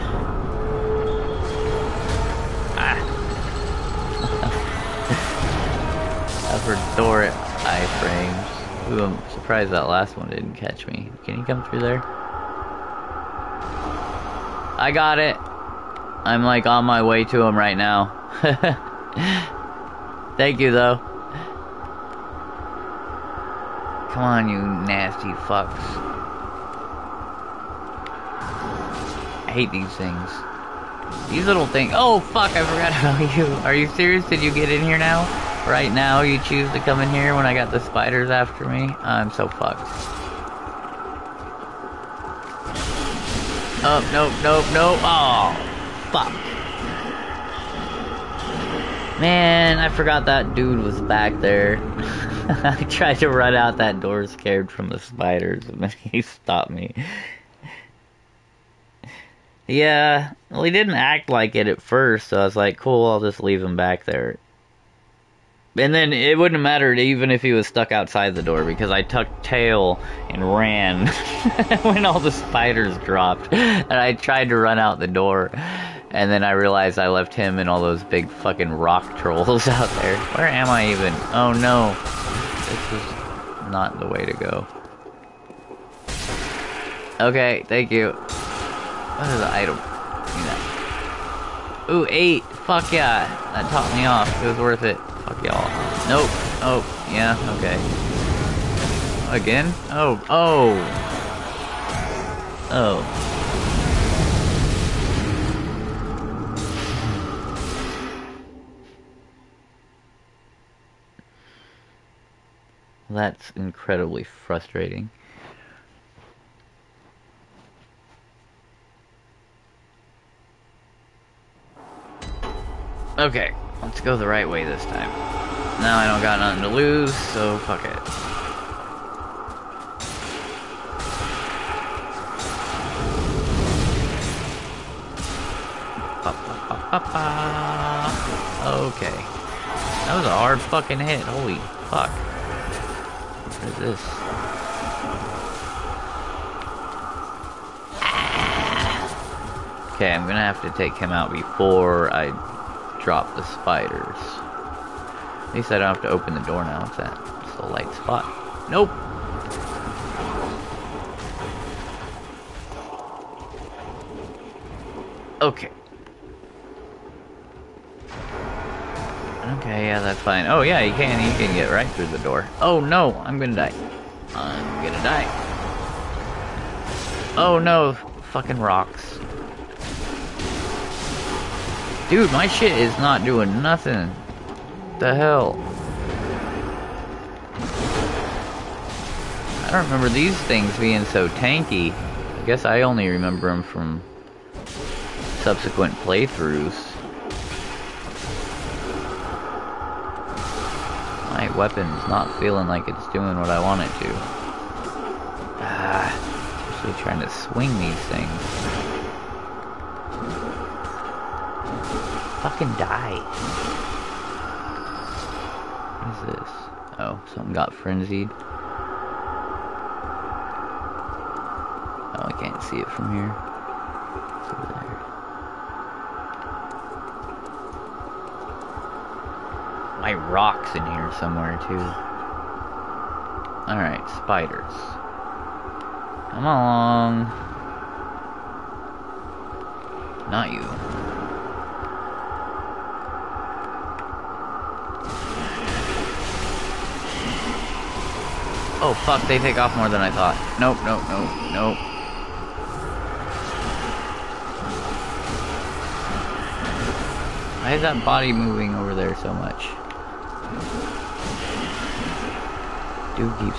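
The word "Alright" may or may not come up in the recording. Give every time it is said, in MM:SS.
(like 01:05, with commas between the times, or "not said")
03:53.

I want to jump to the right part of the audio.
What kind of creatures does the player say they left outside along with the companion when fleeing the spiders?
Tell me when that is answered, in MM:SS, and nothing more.
01:18.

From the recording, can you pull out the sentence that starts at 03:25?
Ah, especially trying to swing these things.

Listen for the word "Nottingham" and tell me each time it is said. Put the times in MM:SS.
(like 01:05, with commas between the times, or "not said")
not said.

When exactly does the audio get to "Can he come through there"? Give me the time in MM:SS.
00:11.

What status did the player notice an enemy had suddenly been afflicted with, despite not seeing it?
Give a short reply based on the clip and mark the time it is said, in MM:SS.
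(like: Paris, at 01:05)
frenzied, at 03:37.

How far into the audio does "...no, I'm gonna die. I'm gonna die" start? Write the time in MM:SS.
02:52.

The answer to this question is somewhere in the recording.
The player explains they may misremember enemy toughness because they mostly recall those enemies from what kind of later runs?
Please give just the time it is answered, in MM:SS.
03:15.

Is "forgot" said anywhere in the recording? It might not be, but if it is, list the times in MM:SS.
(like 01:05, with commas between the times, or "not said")
00:32, 00:49.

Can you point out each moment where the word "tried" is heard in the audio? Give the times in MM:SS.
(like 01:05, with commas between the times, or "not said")
00:52, 01:14.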